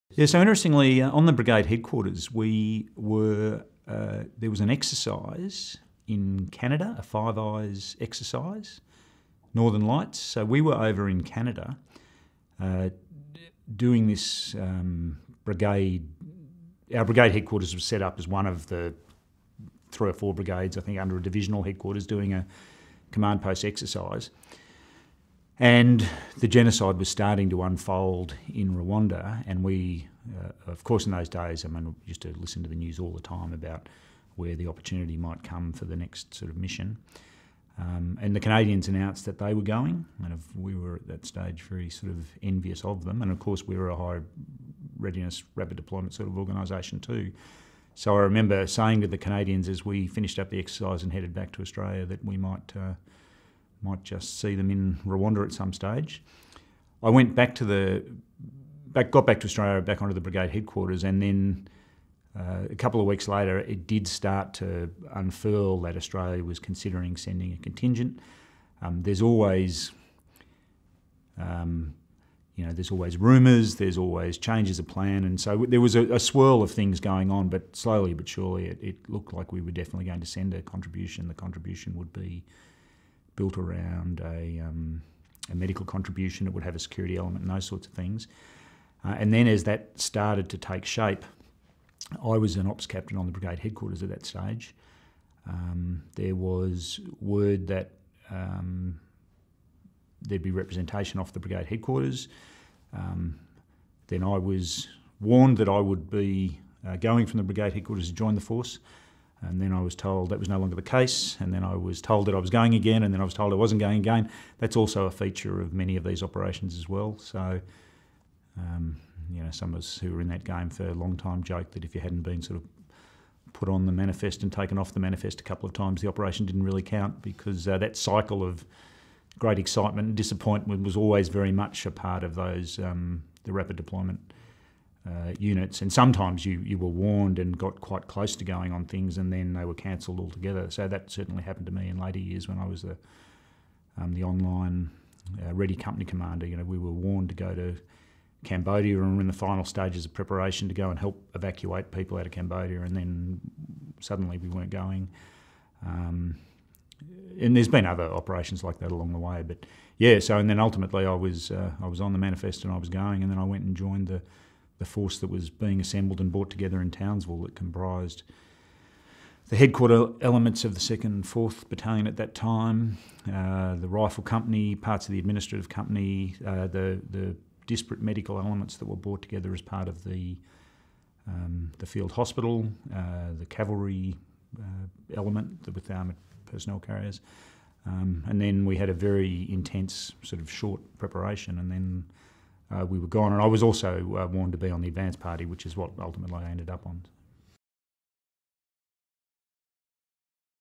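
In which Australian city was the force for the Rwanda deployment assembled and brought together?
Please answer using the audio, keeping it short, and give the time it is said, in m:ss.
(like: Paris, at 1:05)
Townsville, at 2:46.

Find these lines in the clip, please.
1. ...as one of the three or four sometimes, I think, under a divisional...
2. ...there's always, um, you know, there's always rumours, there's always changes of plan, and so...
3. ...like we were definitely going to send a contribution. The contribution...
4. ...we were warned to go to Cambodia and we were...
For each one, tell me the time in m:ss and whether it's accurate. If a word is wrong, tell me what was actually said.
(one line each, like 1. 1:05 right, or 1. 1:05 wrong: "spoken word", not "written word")
1. 0:18 wrong: "brigades", not "sometimes"
2. 1:09 right
3. 1:19 right
4. 2:26 right.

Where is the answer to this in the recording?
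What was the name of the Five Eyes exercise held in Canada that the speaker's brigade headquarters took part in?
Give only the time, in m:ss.
0:09.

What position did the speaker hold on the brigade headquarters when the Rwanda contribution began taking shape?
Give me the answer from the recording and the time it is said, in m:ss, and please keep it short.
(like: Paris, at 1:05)
Ops captain, at 1:32.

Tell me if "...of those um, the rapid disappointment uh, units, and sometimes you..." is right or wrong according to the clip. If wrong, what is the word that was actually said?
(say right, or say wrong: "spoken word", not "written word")
wrong: "deployment", not "disappointment".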